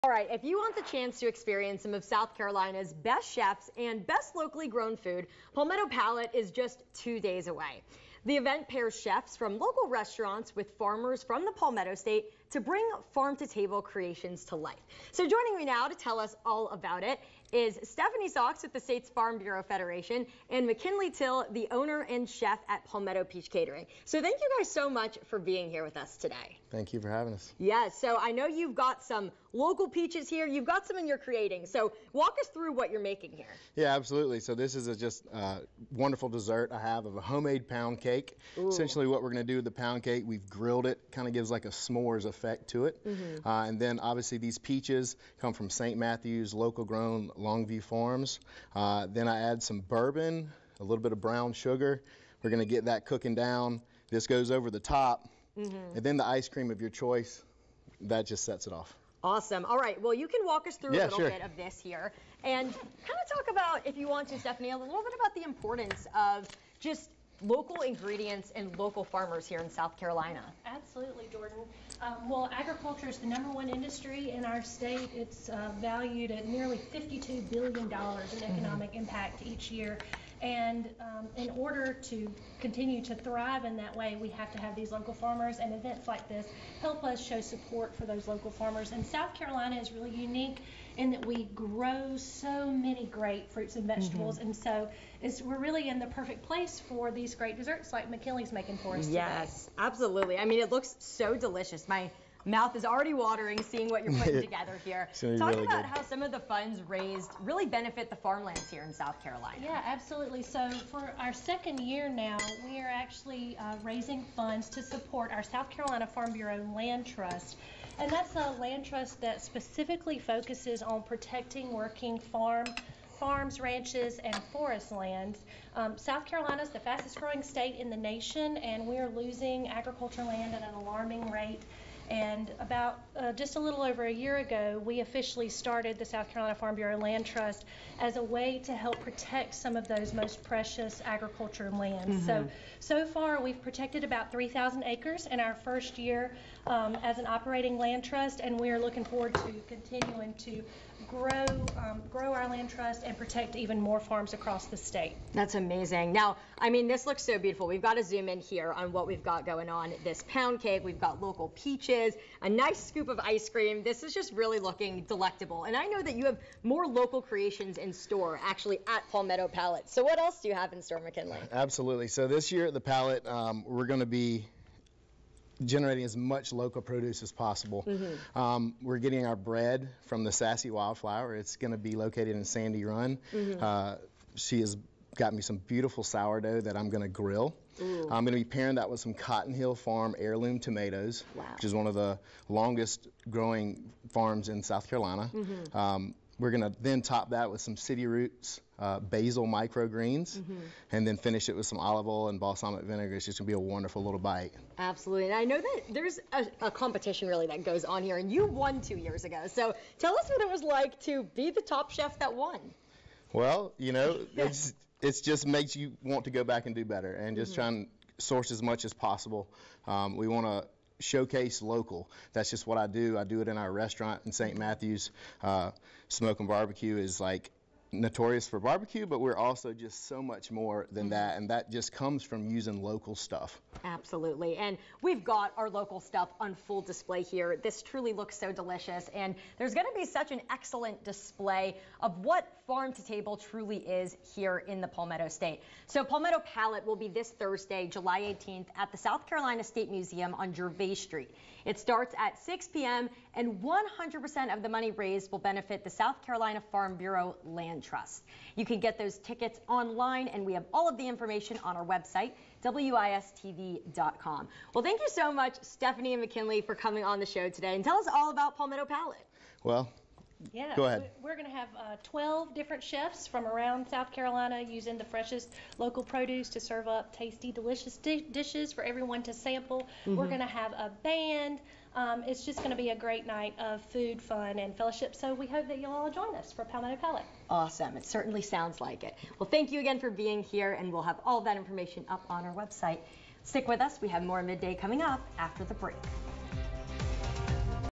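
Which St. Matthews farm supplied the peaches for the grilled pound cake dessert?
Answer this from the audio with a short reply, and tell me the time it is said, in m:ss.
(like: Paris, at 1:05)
Longview Farms, at 0:47.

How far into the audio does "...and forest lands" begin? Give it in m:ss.
2:04.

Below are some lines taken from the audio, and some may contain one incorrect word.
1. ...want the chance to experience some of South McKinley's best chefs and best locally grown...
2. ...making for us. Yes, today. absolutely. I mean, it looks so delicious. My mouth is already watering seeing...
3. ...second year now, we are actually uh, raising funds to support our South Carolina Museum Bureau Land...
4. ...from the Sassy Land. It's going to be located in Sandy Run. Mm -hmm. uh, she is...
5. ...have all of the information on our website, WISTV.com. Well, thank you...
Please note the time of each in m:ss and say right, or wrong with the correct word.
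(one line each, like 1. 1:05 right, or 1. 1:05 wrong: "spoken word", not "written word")
1. 0:00 wrong: "Carolina", not "McKinley"
2. 1:38 right
3. 1:51 wrong: "Farm", not "Museum"
4. 3:00 wrong: "Wildflower", not "Land"
5. 4:20 right.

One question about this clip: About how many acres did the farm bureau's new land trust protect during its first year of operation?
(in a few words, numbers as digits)
3,000 acres.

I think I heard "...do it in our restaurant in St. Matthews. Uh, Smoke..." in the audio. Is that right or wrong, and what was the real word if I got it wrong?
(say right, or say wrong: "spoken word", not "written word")
right.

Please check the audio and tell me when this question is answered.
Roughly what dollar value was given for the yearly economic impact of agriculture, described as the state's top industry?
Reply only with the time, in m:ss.
1:16.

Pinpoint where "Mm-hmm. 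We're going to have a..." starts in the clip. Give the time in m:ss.
4:40.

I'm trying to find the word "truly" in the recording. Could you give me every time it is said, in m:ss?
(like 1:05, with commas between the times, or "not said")
3:57, 4:03.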